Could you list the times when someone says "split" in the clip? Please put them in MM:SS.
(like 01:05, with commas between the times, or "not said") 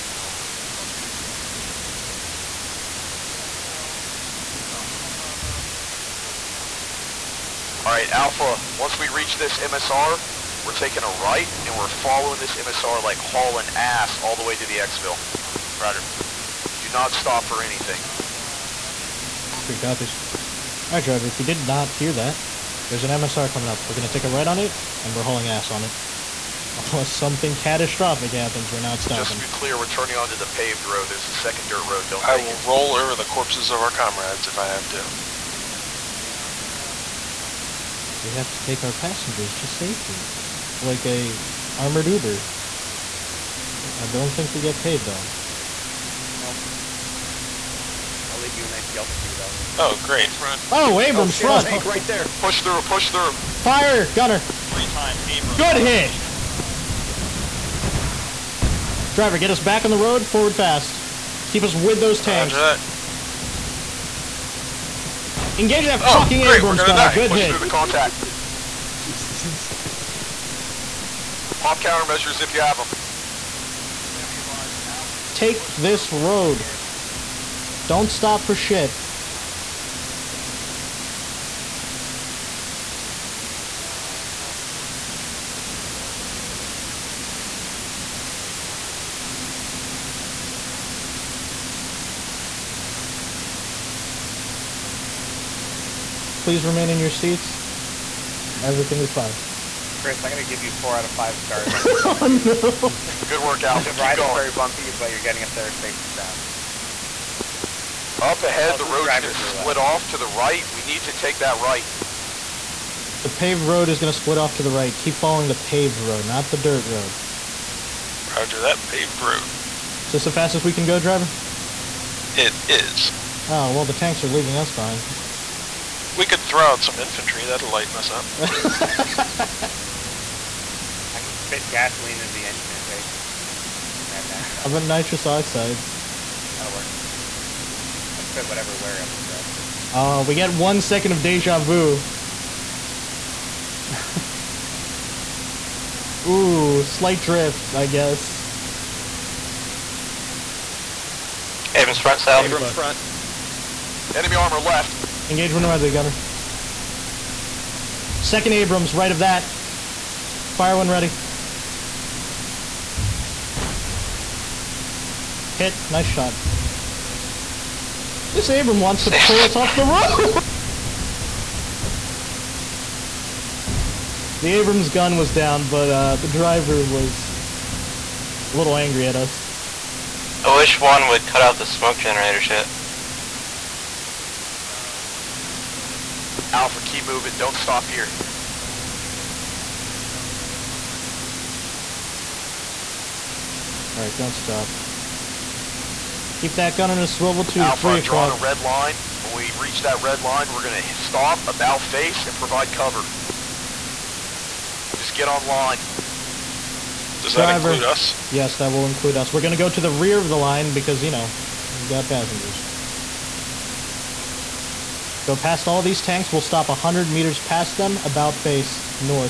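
01:49, 01:54.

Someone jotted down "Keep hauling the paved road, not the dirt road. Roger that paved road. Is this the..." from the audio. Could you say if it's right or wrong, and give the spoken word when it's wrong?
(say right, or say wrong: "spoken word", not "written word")
wrong: "following", not "hauling".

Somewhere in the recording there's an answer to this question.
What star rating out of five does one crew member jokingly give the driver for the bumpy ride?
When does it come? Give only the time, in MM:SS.
01:40.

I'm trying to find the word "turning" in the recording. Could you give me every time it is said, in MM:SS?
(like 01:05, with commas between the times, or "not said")
00:29.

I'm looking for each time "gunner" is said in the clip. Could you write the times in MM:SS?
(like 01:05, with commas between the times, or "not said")
00:54, 02:35.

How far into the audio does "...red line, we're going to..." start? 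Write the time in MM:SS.
03:20.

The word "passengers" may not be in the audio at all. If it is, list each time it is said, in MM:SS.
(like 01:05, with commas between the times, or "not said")
00:38, 03:32.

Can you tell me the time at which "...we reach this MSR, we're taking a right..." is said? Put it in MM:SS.
00:08.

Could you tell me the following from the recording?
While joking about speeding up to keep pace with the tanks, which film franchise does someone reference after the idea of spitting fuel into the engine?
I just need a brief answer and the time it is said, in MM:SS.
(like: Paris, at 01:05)
Mad Max, at 02:14.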